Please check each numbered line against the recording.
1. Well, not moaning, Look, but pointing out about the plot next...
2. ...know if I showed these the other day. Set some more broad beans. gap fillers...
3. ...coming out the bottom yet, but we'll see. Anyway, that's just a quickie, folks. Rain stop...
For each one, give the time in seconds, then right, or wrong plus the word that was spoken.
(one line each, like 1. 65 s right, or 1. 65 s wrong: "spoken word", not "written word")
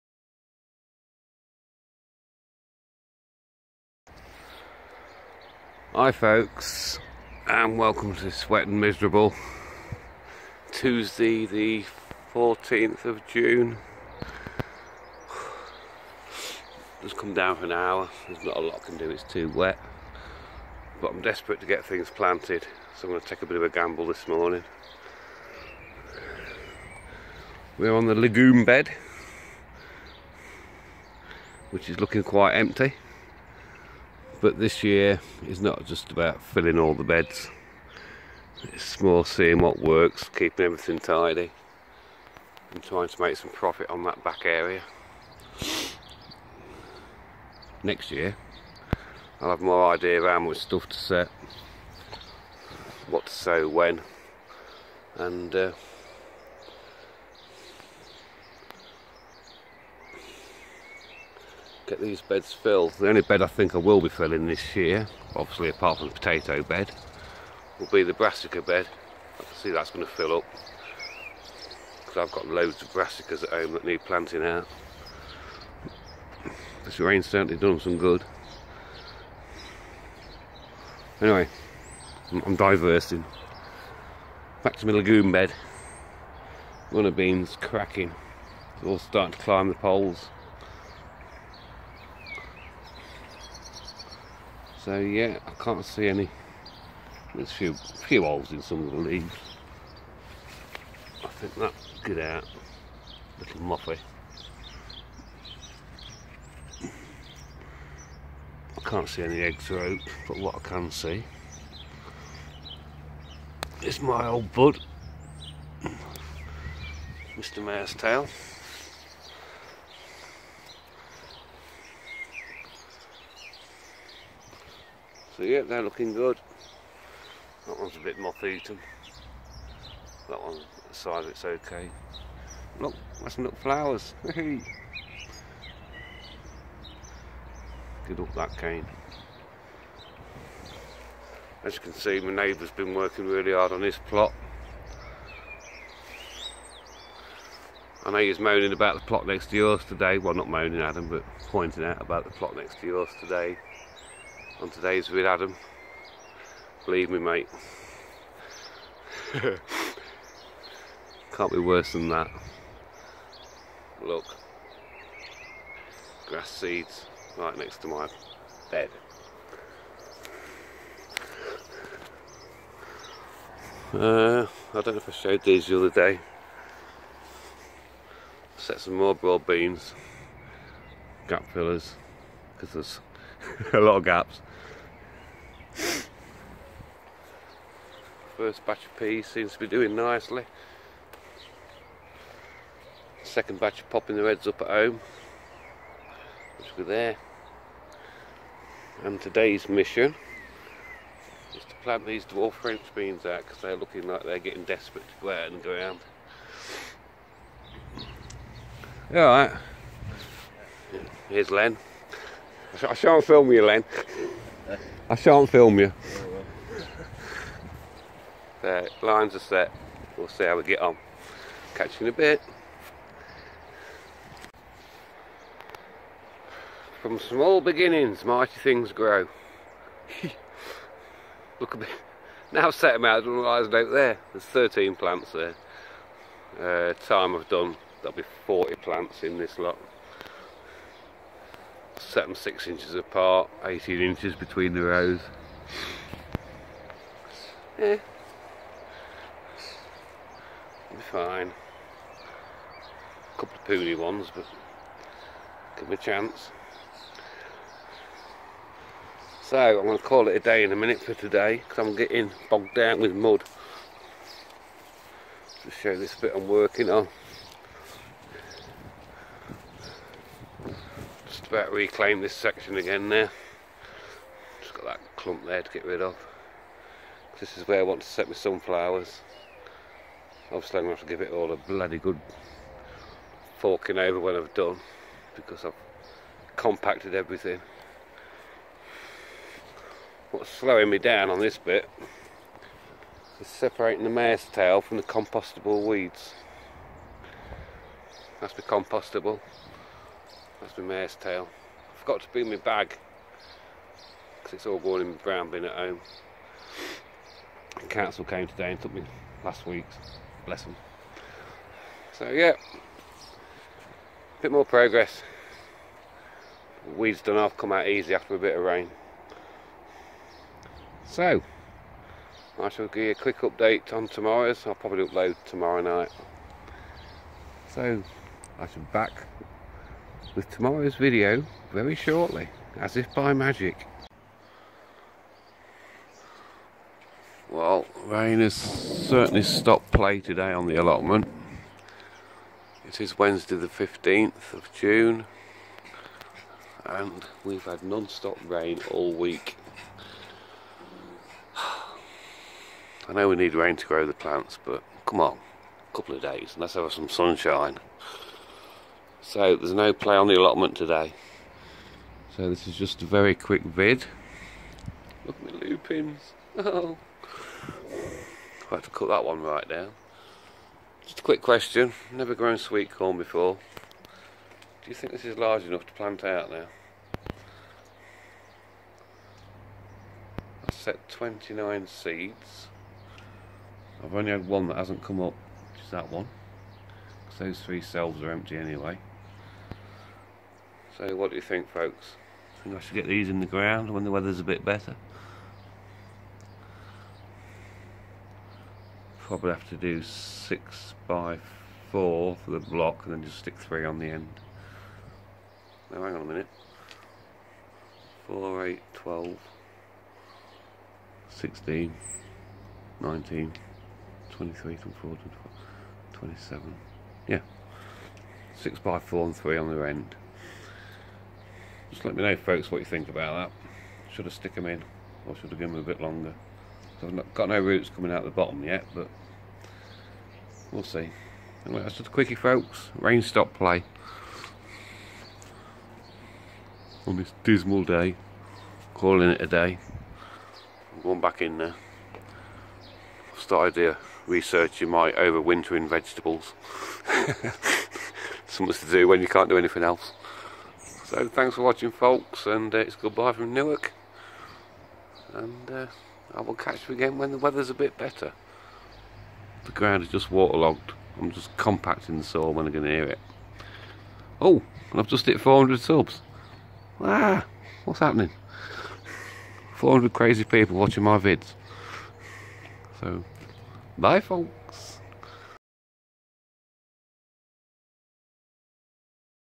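1. 150 s wrong: "Adam", not "Look"
2. 174 s right
3. 427 s right.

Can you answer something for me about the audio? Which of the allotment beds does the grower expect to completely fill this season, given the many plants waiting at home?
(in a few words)
Brassica bed.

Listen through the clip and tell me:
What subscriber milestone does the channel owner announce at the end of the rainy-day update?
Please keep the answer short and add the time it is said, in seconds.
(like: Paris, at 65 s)
400, at 465 s.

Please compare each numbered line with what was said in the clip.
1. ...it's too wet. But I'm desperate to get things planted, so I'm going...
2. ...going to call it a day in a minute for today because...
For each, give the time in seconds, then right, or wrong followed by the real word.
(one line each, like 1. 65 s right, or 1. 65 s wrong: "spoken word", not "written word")
1. 19 s right
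2. 259 s right.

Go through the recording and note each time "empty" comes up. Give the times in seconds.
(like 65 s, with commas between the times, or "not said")
32 s, 388 s.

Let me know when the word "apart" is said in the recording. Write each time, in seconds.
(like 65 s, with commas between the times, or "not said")
65 s, 242 s.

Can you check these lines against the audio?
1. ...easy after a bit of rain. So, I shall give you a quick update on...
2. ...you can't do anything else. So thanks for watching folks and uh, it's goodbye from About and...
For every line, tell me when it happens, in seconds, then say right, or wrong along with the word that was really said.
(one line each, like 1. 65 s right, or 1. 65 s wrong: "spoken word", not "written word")
1. 317 s right
2. 449 s wrong: "Newark", not "About".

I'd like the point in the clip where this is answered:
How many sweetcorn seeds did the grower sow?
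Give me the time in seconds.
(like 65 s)
381 s.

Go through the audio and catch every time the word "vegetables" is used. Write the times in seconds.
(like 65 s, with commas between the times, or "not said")
445 s.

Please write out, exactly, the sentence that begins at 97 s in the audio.
There's a few, few holes in some of the leaves.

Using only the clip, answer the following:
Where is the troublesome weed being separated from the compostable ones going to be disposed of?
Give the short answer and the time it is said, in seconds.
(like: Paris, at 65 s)
Brown bin, at 305 s.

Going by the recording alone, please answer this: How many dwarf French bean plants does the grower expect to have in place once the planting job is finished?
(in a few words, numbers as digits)
40.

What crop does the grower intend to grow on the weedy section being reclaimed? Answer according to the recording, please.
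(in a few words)
Sunflowers.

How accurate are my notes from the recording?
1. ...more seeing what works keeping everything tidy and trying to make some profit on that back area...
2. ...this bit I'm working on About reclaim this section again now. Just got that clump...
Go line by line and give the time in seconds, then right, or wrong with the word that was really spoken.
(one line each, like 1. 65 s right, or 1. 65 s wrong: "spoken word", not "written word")
1. 38 s right
2. 265 s right.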